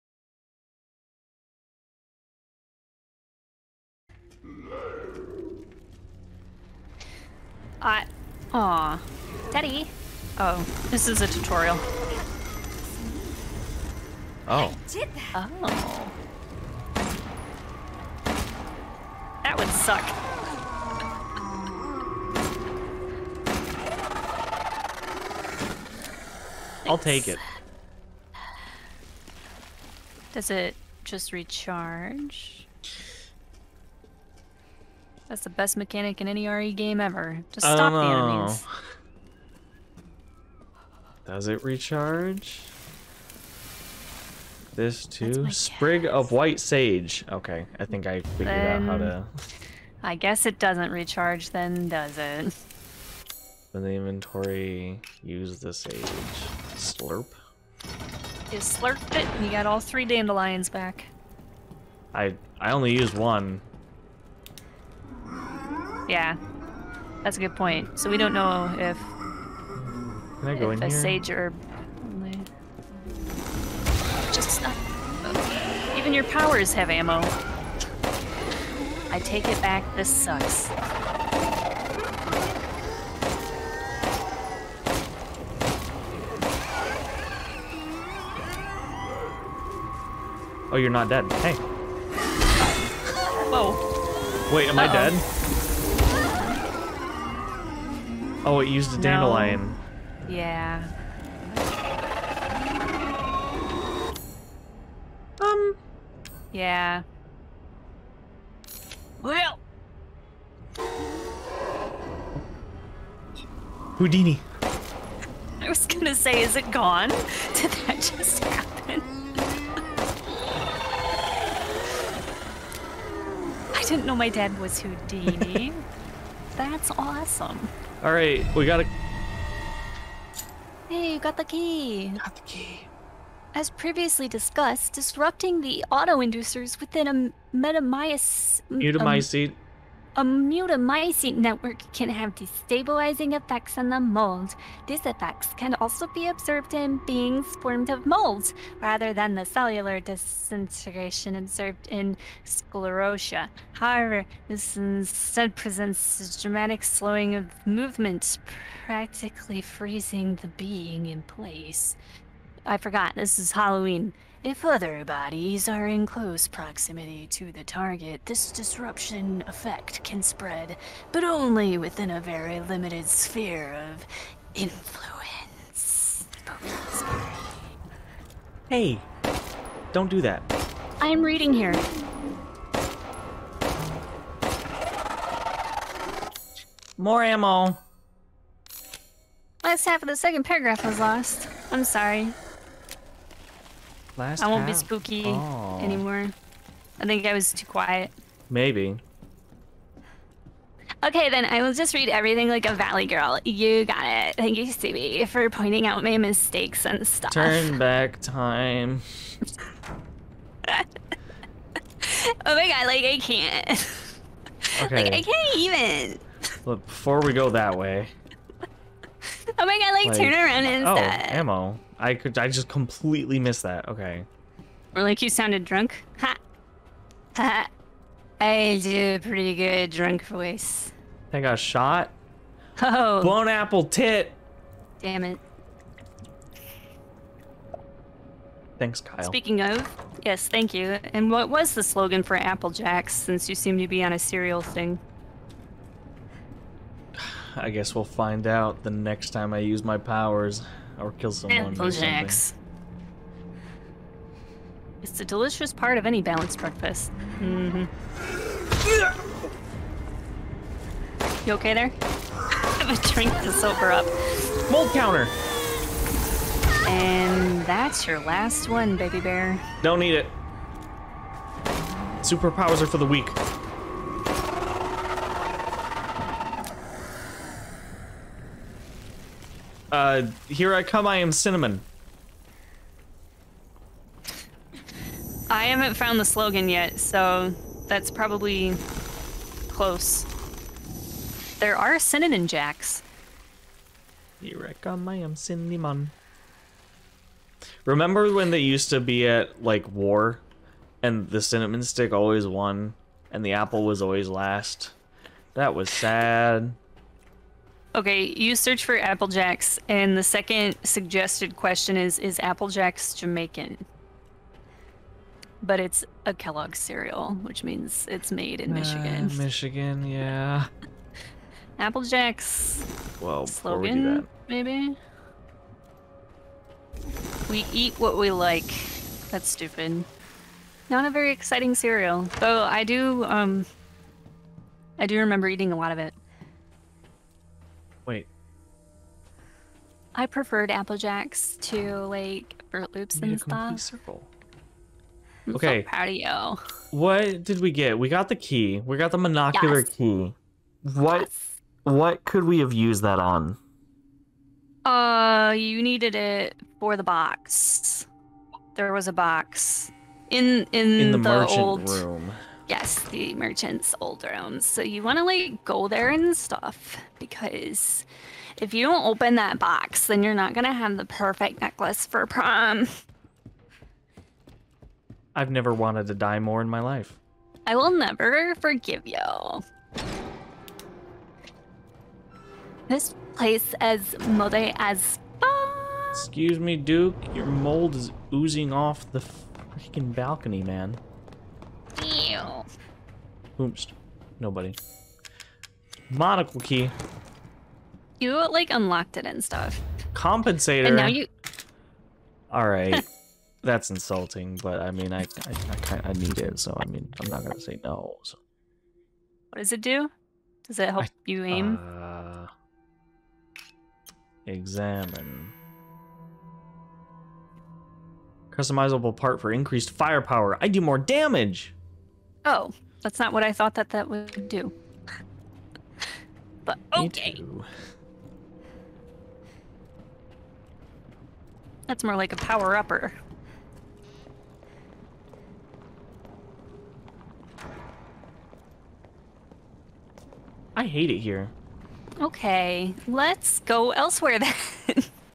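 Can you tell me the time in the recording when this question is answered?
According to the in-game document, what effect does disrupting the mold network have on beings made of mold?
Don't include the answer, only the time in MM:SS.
02:36.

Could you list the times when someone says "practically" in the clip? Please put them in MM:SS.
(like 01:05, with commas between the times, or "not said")
02:38.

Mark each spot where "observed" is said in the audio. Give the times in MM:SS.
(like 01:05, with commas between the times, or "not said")
02:26, 02:31.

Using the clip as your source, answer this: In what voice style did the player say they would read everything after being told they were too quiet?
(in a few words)
valley girl.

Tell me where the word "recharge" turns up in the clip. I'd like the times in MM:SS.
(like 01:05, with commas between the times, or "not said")
00:31, 00:41, 00:50.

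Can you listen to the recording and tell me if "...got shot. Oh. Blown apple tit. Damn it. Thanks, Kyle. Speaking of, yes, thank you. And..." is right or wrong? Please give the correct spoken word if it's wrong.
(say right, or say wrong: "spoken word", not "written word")
right.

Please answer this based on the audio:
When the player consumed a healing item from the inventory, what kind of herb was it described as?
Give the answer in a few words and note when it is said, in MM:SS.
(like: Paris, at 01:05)
White Sage, at 00:46.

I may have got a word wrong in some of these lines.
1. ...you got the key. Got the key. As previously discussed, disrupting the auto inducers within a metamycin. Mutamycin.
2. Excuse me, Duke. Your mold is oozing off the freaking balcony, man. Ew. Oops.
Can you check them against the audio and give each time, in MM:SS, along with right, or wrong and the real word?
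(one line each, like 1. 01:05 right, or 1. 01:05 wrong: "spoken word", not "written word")
1. 02:11 right
2. 06:26 right.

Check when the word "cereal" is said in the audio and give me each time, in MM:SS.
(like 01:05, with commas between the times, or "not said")
04:04, 05:16, 05:31.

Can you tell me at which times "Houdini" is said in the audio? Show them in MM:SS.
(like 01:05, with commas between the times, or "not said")
01:53, 02:04.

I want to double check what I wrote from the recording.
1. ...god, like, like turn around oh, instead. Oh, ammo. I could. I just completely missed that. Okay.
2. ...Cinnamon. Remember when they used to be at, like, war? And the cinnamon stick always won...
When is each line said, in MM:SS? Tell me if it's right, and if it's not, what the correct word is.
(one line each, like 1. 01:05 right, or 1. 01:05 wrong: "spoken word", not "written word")
1. 03:39 right
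2. 04:55 right.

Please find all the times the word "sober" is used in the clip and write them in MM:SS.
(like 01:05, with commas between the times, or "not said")
04:23.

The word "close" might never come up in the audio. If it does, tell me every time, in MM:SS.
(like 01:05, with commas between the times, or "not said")
02:46, 04:49.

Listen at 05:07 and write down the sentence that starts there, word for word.
Okay, you search for Applejacks, and the second suggested question is Is Applejacks Jamaican?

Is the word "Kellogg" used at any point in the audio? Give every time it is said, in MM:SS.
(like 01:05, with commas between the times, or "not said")
05:16.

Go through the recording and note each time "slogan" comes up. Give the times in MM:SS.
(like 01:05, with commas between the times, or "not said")
04:01, 04:46, 05:23.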